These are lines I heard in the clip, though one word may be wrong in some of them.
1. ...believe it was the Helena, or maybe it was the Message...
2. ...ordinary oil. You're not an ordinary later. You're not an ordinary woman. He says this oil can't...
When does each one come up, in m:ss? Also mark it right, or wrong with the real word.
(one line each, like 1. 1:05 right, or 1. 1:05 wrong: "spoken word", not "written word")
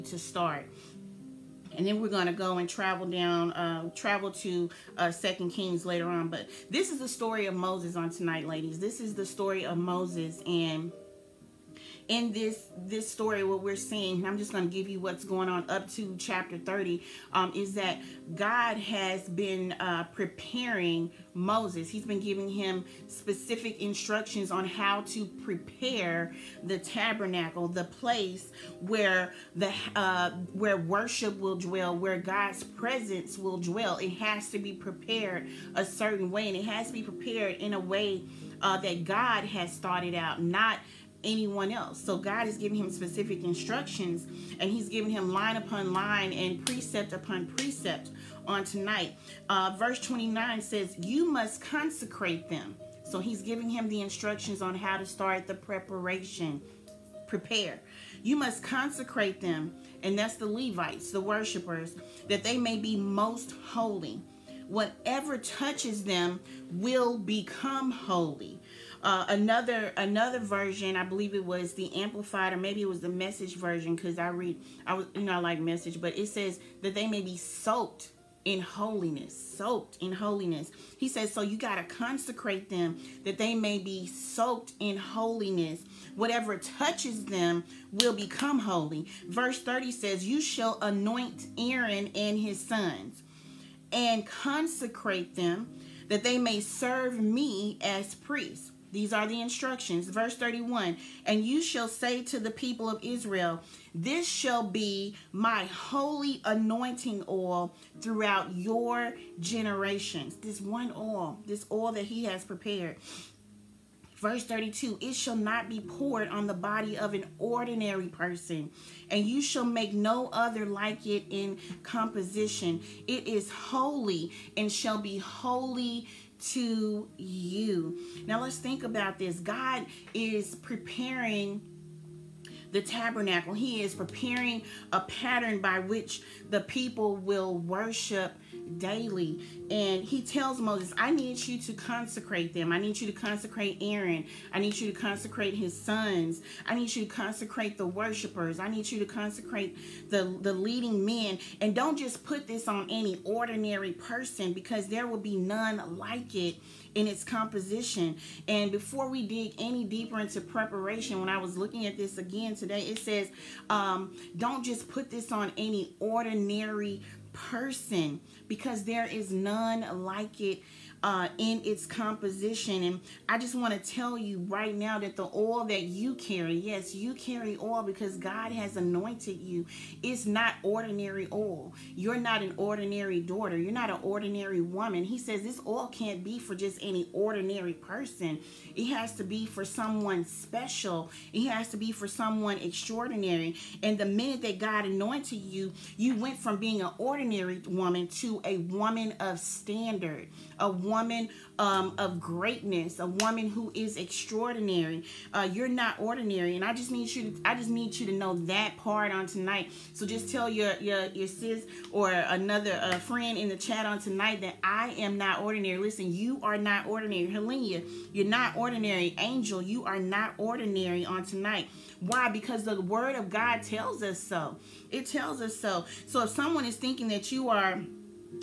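1. 1:11 wrong: "Amplified", not "Helena"
2. 3:00 wrong: "daughter", not "later".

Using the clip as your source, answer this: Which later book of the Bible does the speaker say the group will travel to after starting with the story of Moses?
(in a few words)
Second Kings.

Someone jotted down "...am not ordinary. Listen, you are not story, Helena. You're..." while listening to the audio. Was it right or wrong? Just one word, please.
wrong.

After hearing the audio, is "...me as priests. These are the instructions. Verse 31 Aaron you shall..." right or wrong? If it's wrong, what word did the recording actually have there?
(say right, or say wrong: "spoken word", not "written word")
wrong: "And", not "Aaron".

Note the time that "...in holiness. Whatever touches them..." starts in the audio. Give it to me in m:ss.
1:24.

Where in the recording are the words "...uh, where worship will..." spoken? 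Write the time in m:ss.
0:29.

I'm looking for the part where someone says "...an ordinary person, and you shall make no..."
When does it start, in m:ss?
1:57.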